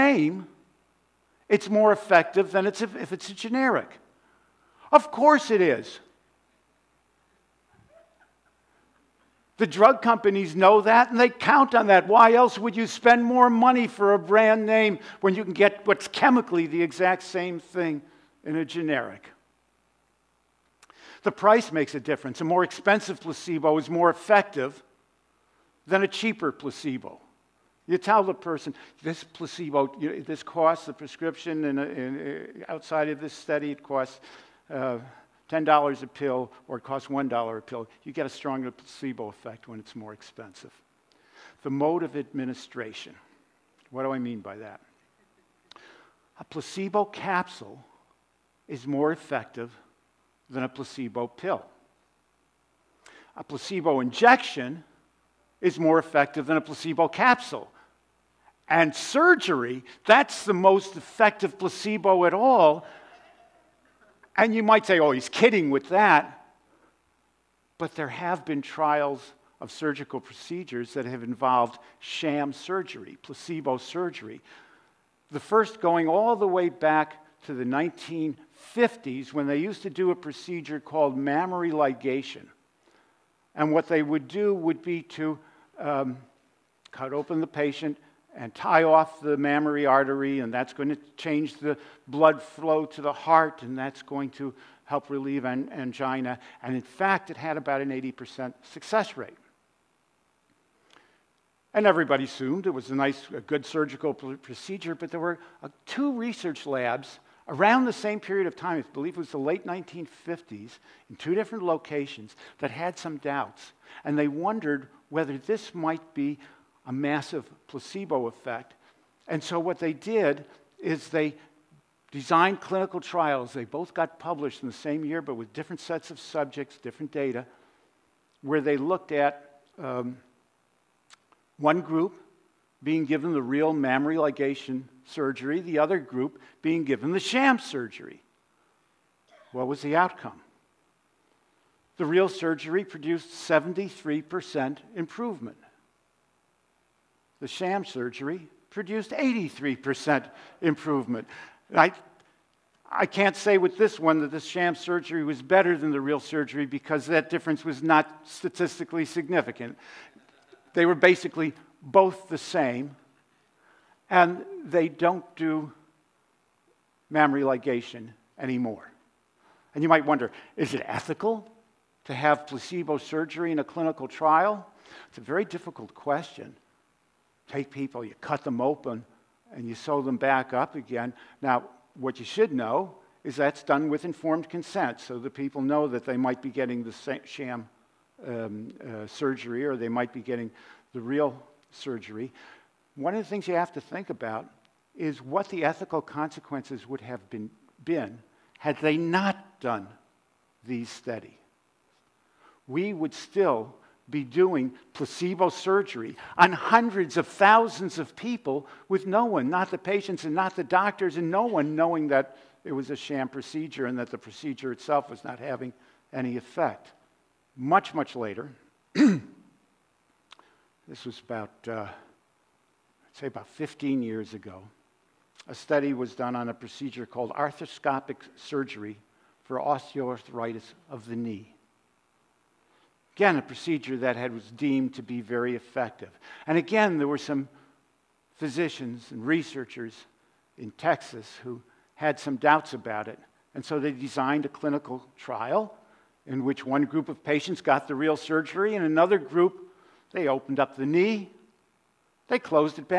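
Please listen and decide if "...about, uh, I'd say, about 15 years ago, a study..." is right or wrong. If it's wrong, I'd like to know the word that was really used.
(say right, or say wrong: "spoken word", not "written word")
right.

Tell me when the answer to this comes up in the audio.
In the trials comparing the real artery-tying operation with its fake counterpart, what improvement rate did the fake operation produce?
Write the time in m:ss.
2:29.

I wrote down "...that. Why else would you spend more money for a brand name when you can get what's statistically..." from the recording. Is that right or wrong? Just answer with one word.
wrong.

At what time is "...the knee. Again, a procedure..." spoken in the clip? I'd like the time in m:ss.
3:51.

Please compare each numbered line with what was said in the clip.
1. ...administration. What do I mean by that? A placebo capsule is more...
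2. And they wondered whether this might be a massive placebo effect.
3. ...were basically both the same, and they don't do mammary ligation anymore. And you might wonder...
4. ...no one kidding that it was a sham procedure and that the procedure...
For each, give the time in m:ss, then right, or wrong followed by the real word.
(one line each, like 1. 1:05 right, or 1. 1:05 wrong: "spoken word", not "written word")
1. 0:42 right
2. 1:54 right
3. 2:40 right
4. 3:31 wrong: "knowing", not "kidding".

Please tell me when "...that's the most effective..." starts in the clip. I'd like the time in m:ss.
1:00.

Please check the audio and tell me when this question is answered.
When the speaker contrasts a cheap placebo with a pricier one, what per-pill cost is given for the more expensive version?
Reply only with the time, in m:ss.
0:35.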